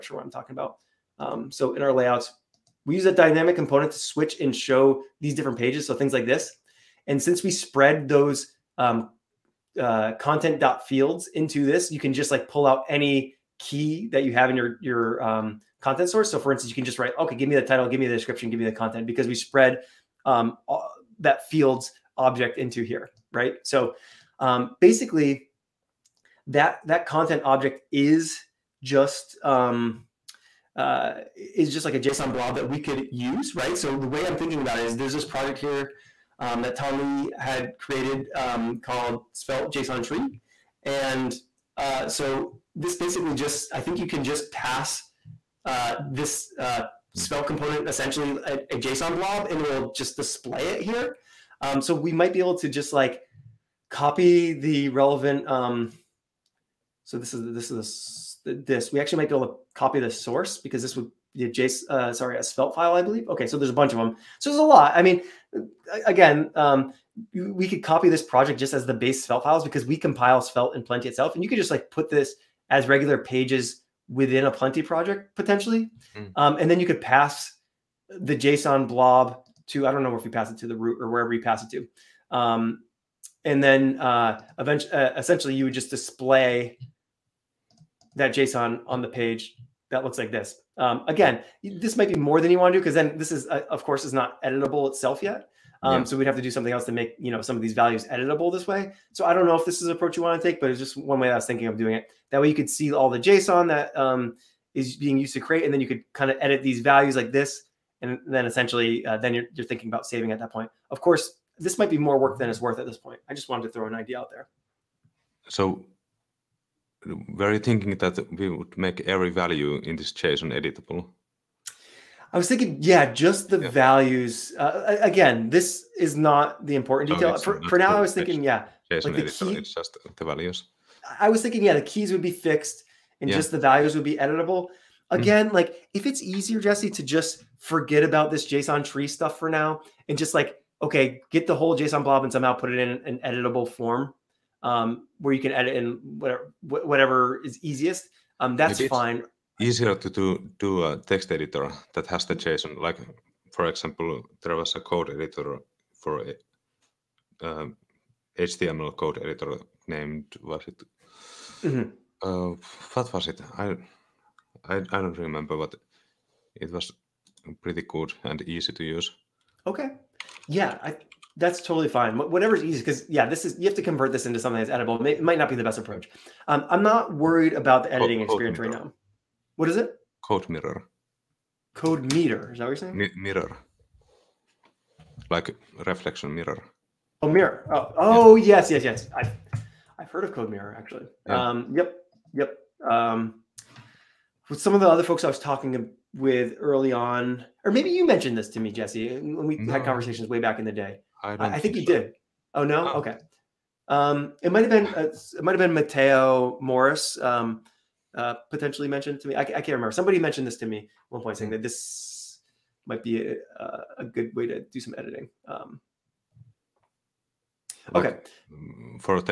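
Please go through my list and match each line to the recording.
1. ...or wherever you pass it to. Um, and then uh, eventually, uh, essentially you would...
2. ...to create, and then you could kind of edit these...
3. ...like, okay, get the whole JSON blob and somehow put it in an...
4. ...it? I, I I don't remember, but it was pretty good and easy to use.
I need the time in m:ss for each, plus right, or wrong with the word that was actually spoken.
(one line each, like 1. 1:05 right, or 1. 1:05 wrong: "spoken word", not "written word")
1. 1:20 right
2. 1:45 right
3. 2:20 right
4. 2:43 right.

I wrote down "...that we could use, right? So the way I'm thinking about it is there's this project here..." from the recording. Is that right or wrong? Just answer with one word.
right.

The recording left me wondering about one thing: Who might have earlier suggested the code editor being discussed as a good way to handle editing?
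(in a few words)
Matteo Morris.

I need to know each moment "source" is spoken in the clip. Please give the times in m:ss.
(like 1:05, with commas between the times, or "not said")
0:16, 1:00.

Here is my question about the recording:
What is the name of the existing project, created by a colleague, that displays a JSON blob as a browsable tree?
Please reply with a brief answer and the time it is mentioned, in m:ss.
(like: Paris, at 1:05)
Svelte JSON Tree, at 0:39.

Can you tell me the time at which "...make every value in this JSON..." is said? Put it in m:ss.
1:58.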